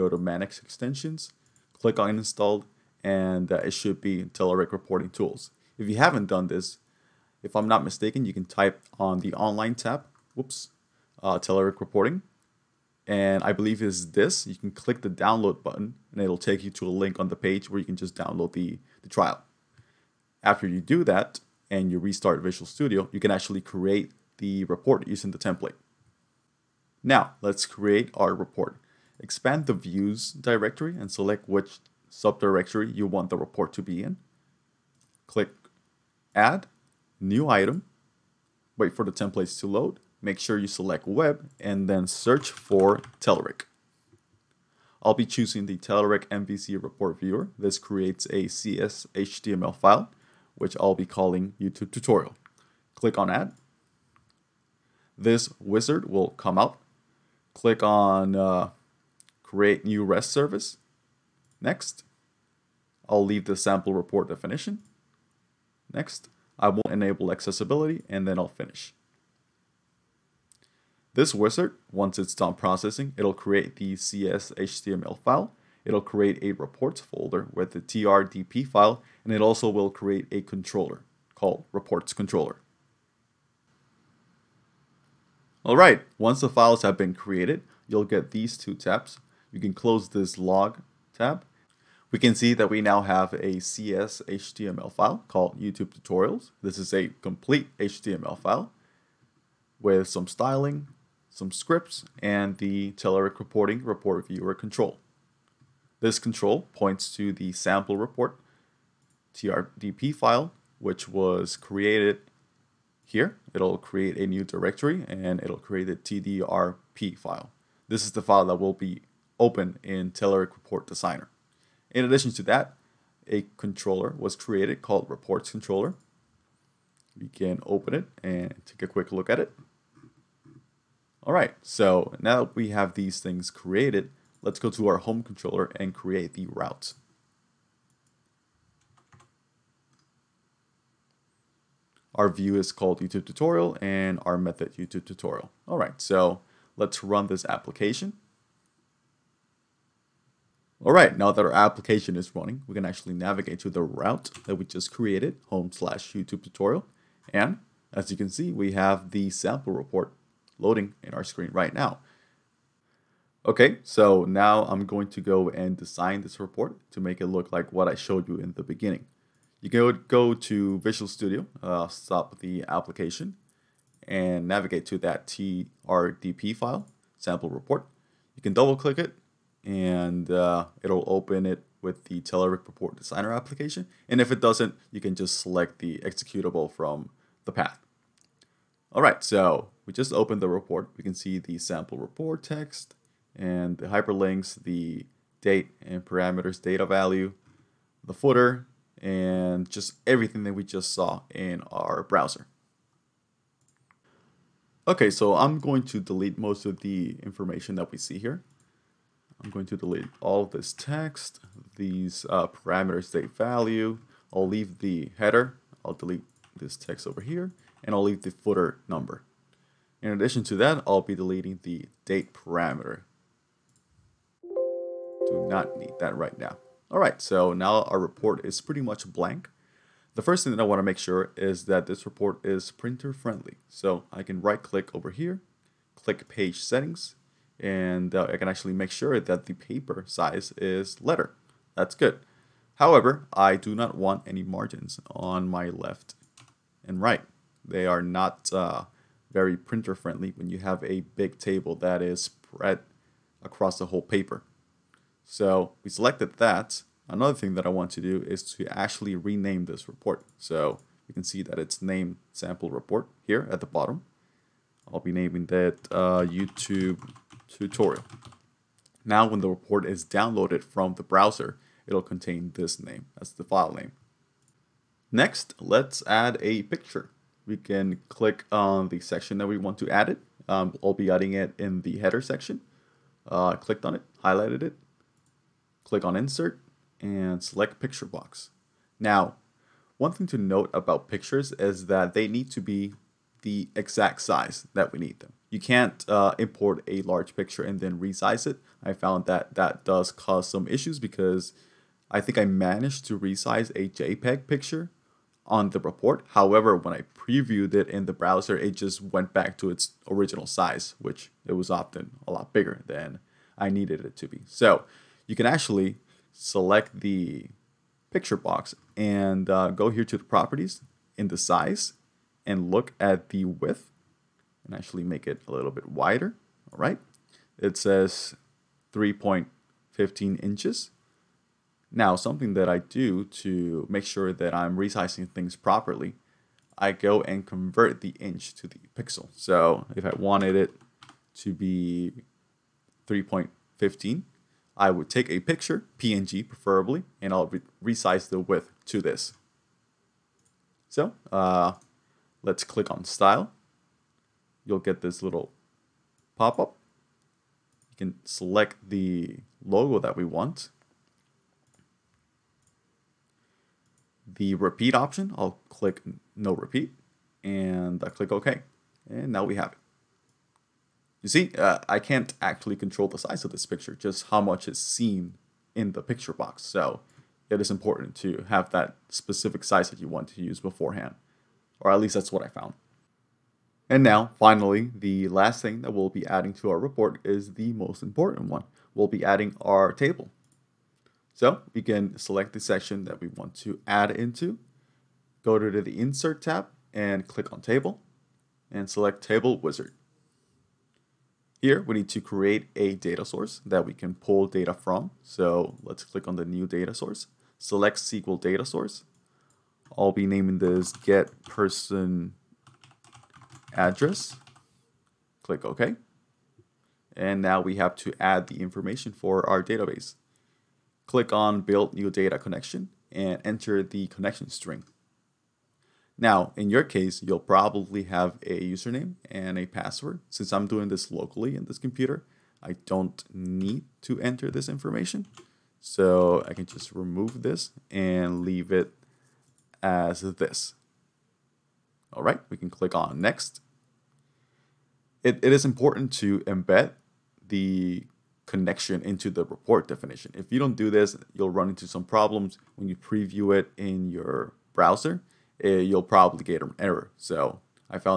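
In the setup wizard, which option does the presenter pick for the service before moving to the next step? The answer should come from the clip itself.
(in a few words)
create new REST service.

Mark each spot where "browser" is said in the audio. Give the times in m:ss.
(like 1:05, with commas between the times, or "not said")
3:22, 4:31, 5:08, 7:34.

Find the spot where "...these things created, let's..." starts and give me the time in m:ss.
2:12.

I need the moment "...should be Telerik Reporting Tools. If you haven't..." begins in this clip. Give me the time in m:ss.
0:03.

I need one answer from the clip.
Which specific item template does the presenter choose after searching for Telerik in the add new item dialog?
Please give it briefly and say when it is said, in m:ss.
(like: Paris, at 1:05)
Telerik MVC report viewer, at 0:45.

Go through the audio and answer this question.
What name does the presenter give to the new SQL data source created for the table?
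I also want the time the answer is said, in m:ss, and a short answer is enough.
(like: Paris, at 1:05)
get person address, at 6:50.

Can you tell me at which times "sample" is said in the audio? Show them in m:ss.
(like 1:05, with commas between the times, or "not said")
1:03, 1:47, 2:39, 2:57, 3:11, 4:22.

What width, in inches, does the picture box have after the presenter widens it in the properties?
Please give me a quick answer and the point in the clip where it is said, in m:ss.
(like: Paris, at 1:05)
3.15 inches, at 5:28.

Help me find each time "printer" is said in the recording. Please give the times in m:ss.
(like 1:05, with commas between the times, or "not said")
3:52, 4:09.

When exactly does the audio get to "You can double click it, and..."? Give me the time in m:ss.
2:58.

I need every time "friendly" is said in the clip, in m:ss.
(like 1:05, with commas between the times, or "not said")
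3:53, 4:09.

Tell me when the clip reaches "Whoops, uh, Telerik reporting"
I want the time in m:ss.
0:10.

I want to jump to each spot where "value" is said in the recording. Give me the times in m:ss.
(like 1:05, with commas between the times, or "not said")
3:16, 3:33.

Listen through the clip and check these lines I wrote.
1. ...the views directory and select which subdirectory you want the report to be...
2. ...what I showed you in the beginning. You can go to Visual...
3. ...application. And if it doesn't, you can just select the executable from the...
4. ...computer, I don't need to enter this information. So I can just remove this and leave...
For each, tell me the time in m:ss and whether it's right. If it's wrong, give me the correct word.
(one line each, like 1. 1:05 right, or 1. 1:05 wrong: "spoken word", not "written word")
1. 0:29 right
2. 2:47 right
3. 3:03 right
4. 7:11 right.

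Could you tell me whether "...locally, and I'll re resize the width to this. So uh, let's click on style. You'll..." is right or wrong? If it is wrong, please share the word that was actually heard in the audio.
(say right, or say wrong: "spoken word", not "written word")
wrong: "preferably", not "locally".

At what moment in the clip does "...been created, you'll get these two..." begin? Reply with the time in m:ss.
1:26.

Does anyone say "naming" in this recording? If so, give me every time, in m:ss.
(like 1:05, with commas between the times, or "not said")
4:25, 6:50.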